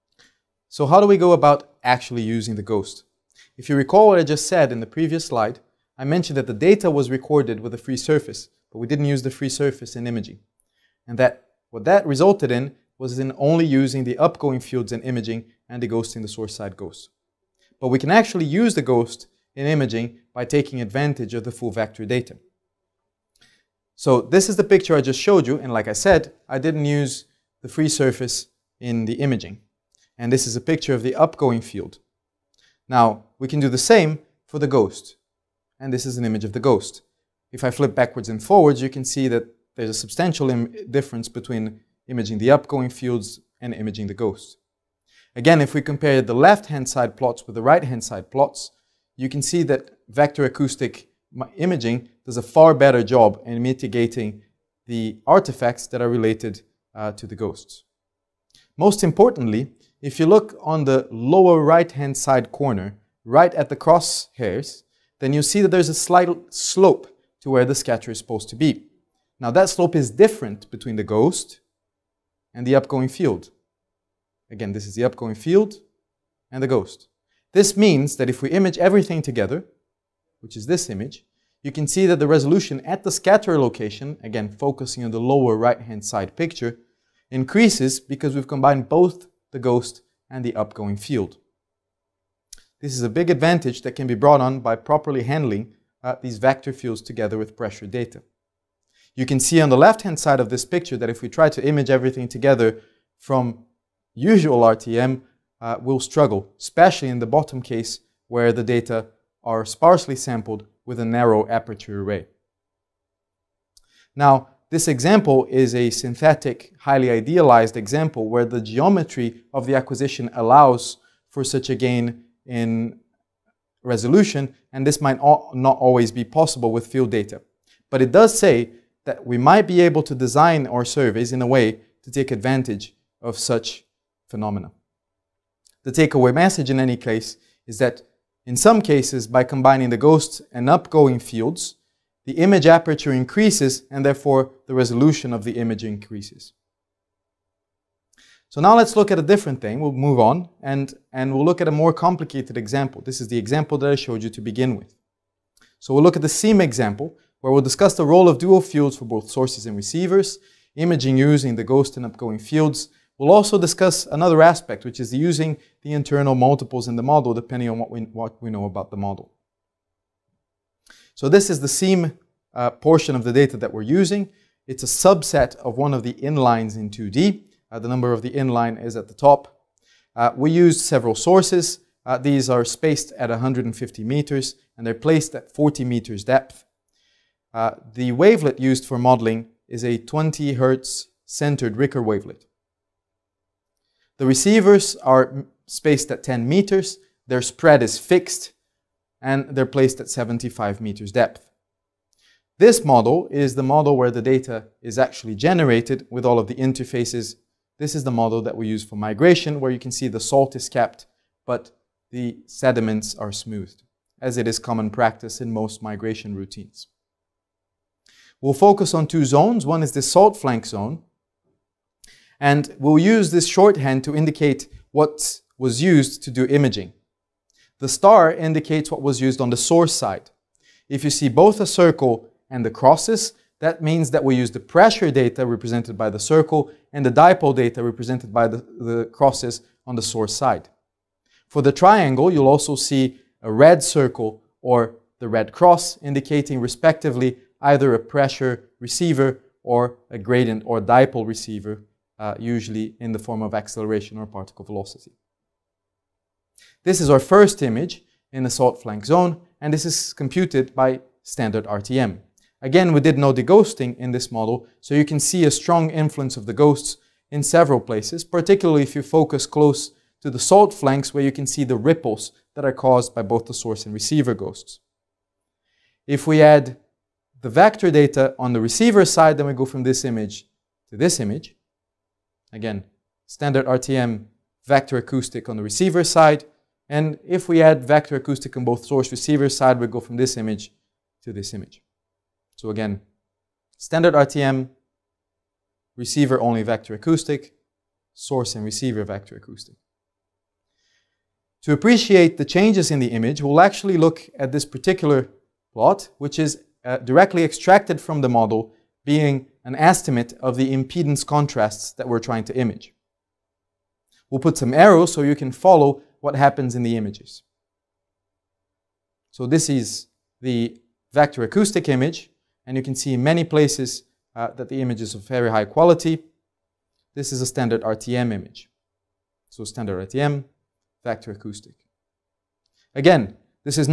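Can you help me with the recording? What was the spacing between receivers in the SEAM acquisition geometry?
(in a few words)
10 meters.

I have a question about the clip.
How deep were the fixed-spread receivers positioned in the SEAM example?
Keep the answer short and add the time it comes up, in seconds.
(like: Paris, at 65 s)
75 meters, at 200 s.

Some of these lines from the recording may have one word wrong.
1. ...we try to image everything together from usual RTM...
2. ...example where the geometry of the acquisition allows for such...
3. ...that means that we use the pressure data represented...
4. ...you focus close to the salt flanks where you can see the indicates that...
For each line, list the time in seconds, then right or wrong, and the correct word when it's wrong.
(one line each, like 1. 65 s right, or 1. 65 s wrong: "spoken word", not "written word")
1. 101 s right
2. 117 s right
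3. 233 s right
4. 268 s wrong: "ripples", not "indicates".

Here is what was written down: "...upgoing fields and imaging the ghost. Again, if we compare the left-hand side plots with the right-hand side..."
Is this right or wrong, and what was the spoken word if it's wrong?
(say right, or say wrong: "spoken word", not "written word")
right.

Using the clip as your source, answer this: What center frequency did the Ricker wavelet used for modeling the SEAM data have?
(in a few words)
20 hertz.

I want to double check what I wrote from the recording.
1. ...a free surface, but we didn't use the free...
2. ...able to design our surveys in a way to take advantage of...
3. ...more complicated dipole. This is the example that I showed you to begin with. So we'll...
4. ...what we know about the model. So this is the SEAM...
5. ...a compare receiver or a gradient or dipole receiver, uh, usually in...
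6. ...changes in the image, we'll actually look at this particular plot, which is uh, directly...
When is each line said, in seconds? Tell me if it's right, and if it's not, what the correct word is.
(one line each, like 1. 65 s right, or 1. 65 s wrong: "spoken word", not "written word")
1. 7 s right
2. 129 s right
3. 151 s wrong: "example", not "dipole"
4. 168 s right
5. 247 s wrong: "pressure", not "compare"
6. 302 s right.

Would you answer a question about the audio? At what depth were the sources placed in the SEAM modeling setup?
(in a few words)
40 meters.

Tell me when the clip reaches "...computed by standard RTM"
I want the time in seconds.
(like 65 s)
260 s.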